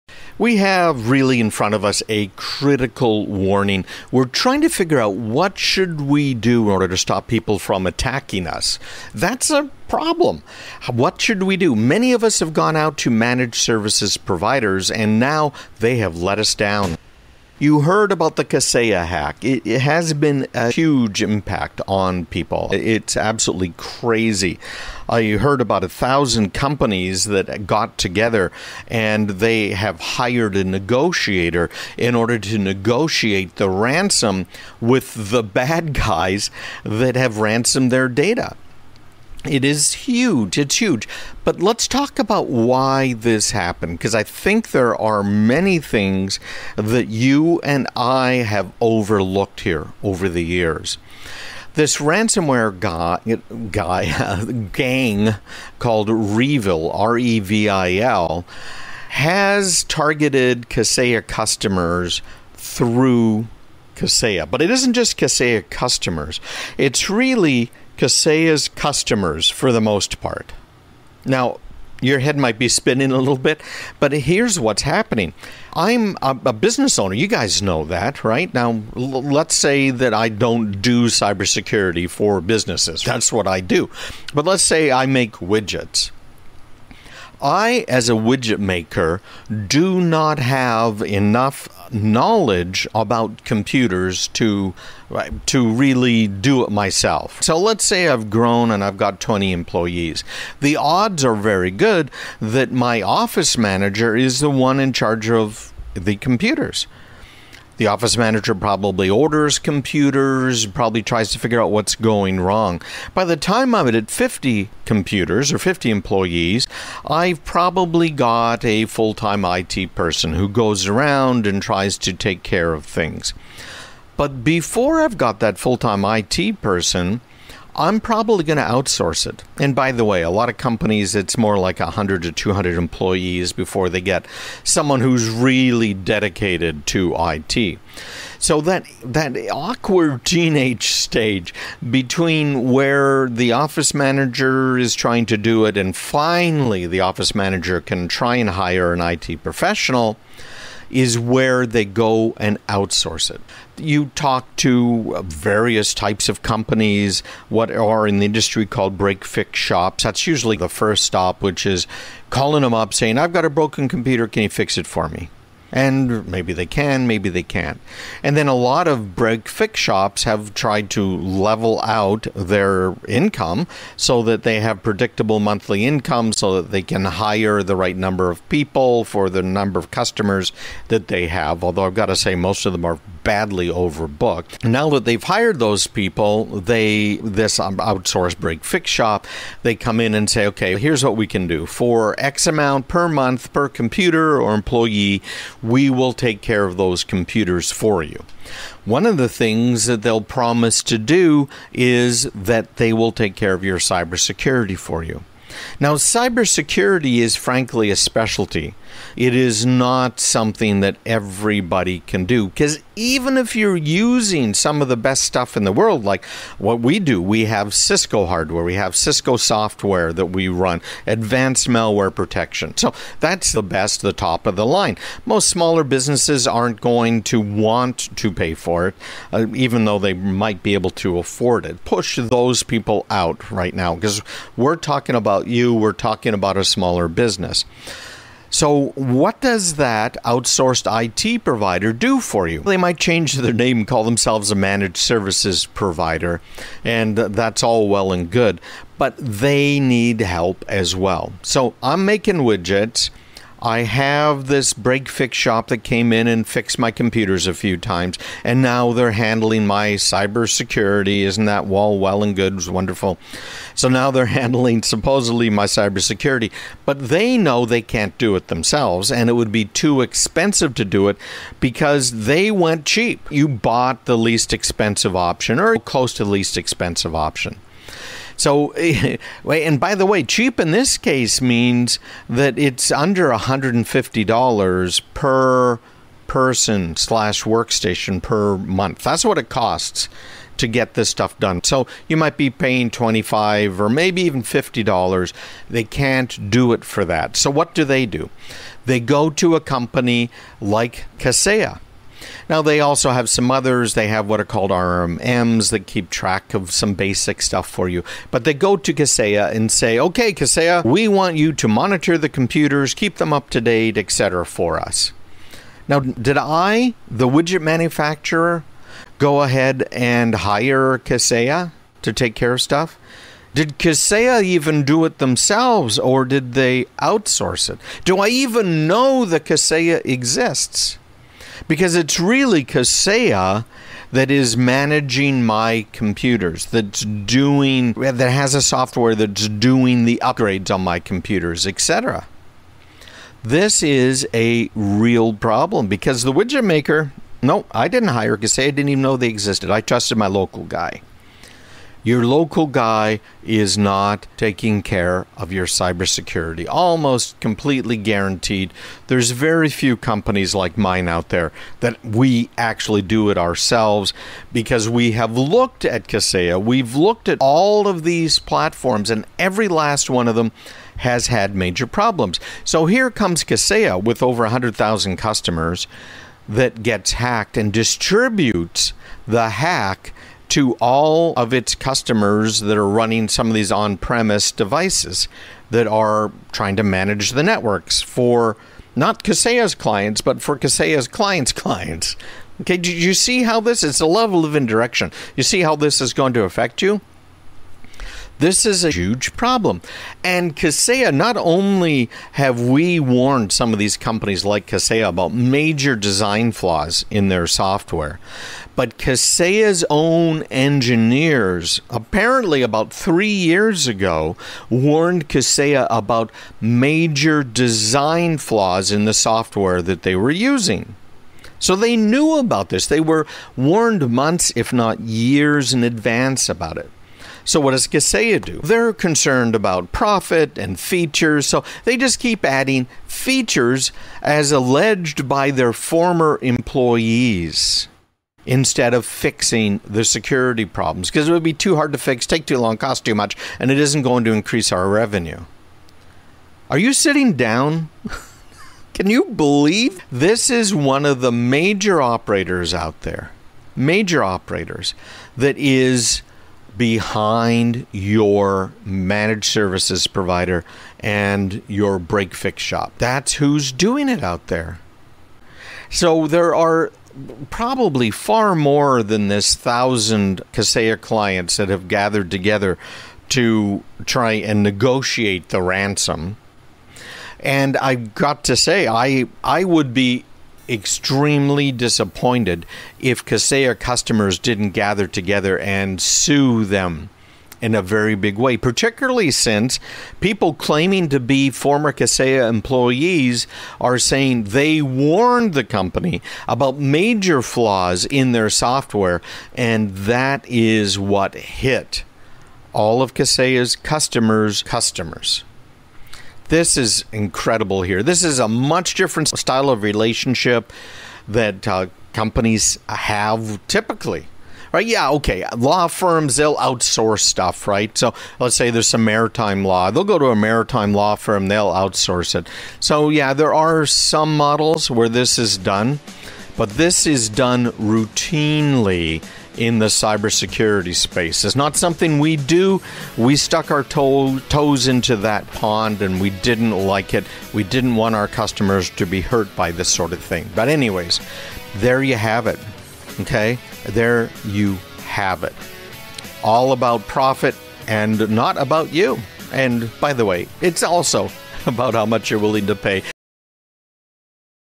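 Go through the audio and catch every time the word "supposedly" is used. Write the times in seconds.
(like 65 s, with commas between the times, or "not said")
264 s.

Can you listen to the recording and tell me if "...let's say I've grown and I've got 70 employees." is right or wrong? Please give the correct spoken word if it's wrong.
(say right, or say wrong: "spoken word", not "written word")
wrong: "20", not "70".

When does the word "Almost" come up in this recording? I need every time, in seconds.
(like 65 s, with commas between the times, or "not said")
356 s.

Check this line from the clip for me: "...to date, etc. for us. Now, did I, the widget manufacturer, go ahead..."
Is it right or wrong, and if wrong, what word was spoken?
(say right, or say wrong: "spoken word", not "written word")
right.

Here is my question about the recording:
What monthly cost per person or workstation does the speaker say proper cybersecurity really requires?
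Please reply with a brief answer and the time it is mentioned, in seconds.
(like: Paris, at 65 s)
$150, at 283 s.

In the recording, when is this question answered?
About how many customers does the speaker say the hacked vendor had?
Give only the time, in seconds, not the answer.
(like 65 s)
374 s.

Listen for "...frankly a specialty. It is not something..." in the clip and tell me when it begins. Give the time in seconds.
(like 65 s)
207 s.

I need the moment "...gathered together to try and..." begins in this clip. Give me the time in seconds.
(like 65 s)
471 s.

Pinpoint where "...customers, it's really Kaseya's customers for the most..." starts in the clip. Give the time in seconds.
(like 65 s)
65 s.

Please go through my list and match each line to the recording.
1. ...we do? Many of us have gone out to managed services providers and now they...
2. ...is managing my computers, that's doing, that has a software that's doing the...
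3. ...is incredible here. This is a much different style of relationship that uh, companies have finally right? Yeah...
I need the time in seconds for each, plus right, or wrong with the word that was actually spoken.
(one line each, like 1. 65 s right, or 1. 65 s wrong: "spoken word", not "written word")
1. 11 s right
2. 334 s right
3. 506 s wrong: "typically", not "finally".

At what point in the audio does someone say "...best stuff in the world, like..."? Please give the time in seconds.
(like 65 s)
214 s.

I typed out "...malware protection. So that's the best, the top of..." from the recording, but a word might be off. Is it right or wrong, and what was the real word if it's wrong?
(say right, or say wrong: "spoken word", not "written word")
right.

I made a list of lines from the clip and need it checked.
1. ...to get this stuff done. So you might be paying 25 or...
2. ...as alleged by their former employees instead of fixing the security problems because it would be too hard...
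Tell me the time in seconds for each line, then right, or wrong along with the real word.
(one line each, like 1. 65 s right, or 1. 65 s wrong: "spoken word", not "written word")
1. 290 s right
2. 434 s right.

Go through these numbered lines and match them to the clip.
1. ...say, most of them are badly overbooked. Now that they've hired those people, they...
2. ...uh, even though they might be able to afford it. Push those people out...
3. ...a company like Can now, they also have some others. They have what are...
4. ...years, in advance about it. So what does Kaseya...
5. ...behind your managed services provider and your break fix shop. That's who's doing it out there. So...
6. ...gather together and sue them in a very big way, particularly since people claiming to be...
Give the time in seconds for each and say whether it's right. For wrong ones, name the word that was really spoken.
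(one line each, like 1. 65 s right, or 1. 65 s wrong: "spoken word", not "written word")
1. 182 s right
2. 229 s right
3. 299 s wrong: "Kaseya", not "Can"
4. 424 s right
5. 456 s right
6. 484 s right.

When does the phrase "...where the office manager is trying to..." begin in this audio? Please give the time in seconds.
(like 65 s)
142 s.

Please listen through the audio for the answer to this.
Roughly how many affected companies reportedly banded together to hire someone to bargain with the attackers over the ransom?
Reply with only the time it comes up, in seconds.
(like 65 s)
25 s.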